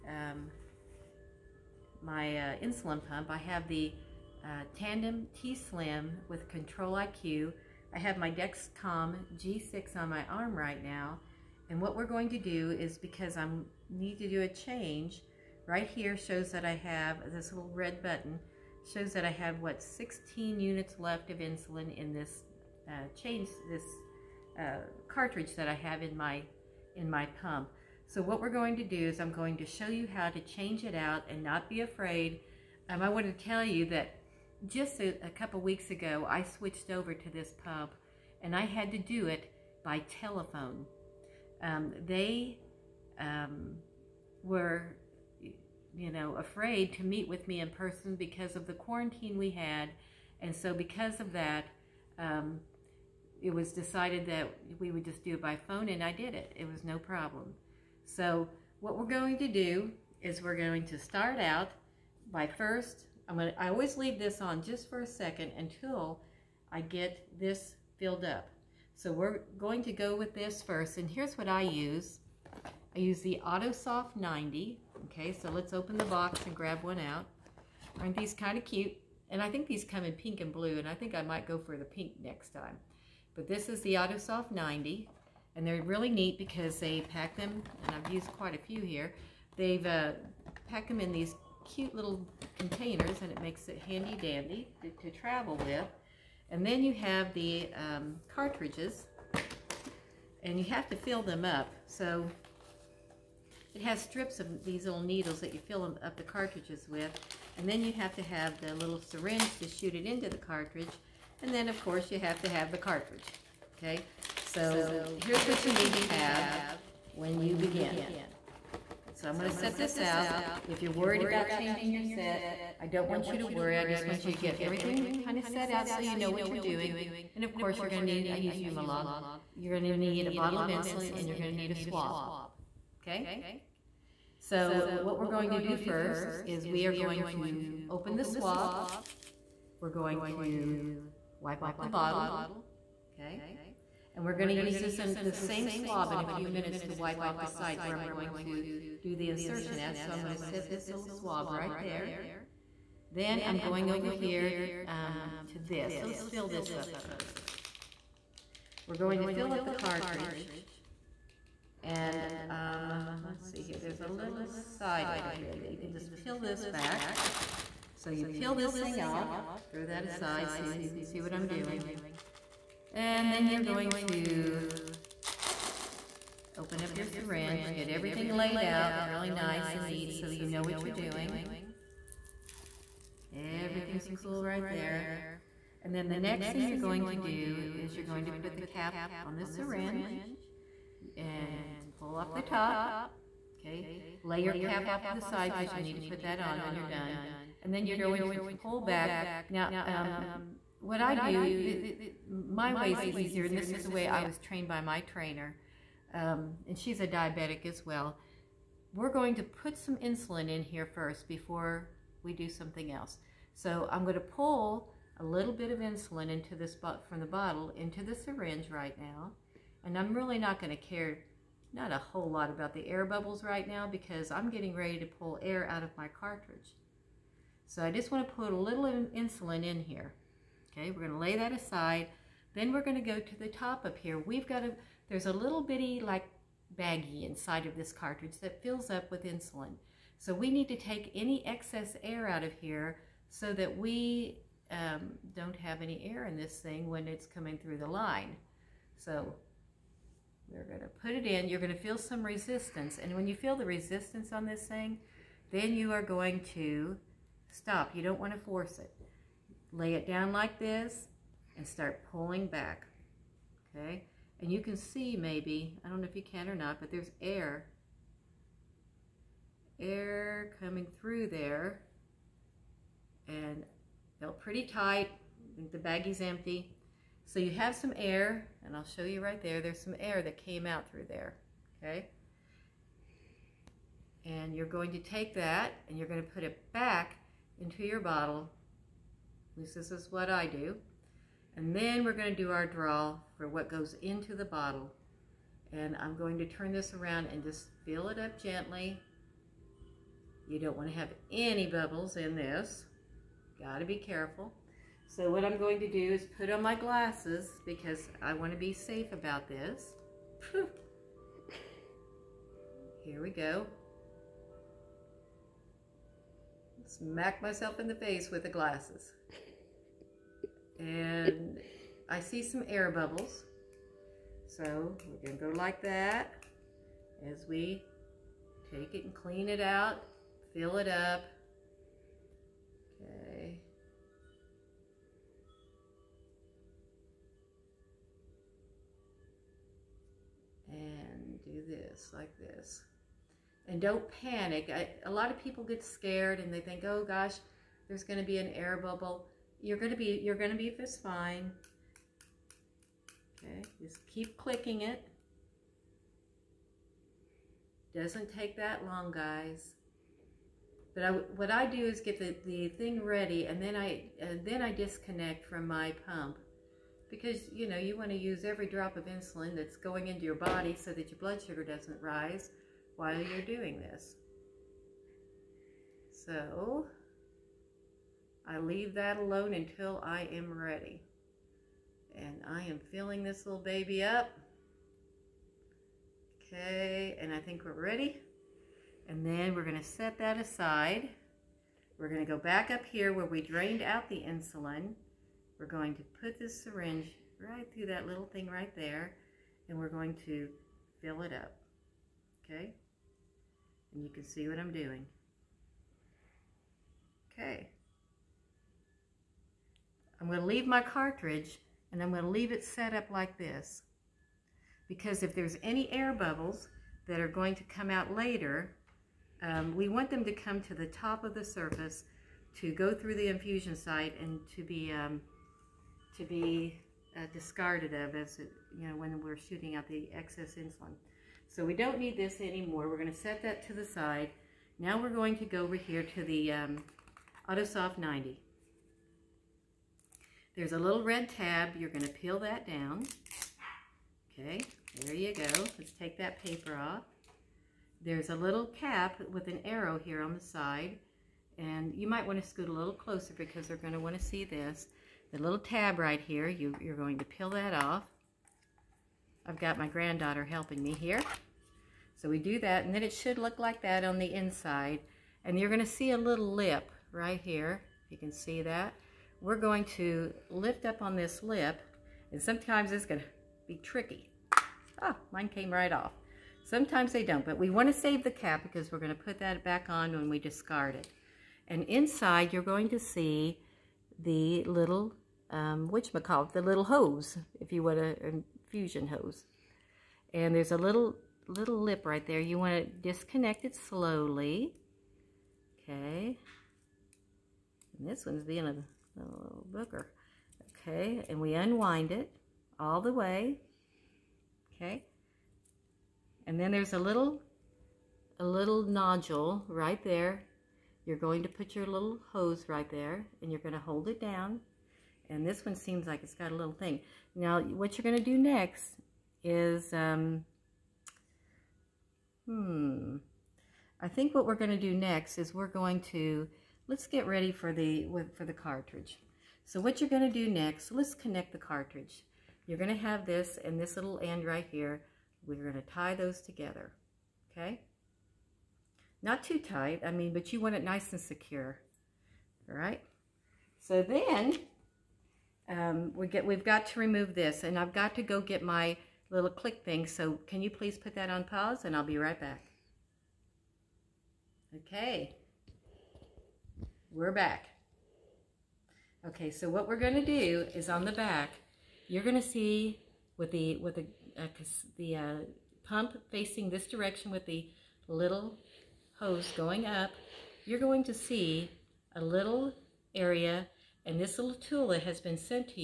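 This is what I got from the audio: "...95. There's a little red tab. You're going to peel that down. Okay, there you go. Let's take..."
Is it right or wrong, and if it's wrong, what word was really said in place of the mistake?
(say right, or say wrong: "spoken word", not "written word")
wrong: "90", not "95".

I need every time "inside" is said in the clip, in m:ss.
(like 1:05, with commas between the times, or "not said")
3:57, 7:44, 8:01.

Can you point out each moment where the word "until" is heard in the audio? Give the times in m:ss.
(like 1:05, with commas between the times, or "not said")
1:05, 6:19.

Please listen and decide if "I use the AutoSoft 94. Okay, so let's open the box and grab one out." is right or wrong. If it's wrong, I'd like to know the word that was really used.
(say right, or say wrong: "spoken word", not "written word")
wrong: "90", not "94".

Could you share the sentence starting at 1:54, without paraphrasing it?
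So here's what you need to have when you begin.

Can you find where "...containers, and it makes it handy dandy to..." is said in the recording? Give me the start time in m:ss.
1:32.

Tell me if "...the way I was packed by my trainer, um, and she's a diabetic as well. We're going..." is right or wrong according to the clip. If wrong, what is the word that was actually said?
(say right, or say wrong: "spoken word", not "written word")
wrong: "trained", not "packed".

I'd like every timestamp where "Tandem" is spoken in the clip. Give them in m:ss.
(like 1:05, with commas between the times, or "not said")
0:04.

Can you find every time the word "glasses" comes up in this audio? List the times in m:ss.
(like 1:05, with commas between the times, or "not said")
5:06, 5:18.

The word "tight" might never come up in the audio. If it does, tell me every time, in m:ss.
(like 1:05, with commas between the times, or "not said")
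4:34, 8:59.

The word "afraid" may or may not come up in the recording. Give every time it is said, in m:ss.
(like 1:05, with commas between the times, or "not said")
0:31, 0:46.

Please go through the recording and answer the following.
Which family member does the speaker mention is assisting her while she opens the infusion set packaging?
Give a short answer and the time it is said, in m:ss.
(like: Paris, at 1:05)
granddaughter, at 7:39.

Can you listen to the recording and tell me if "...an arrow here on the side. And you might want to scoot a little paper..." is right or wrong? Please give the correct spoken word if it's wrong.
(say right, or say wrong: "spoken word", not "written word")
wrong: "closer", not "paper".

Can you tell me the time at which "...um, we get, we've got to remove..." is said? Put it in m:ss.
9:05.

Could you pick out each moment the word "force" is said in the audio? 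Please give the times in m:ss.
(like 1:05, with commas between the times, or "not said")
4:18.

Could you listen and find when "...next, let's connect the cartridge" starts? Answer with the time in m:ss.
8:50.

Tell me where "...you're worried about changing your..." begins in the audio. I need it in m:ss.
2:00.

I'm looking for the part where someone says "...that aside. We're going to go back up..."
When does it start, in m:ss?
6:30.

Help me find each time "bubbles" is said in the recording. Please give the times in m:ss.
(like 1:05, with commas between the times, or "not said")
3:43, 5:01, 5:22, 5:48, 6:56.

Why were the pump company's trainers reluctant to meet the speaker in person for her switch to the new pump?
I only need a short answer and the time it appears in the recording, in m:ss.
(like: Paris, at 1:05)
quarantine, at 0:48.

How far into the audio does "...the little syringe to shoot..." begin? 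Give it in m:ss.
1:48.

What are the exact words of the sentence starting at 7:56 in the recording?
Sometimes they don't, but we want to save the cap because we're going to put that back on when we discard it.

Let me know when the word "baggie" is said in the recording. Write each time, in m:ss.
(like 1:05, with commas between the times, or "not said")
3:56, 4:35.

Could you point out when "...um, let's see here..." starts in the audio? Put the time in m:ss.
2:42.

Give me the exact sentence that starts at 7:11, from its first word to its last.
So we don't need this anymore.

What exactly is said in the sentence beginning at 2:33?
Then I'm going over here um, to this.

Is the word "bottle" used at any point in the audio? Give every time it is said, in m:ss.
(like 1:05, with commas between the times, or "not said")
2:10, 2:21, 3:37, 4:47, 4:54.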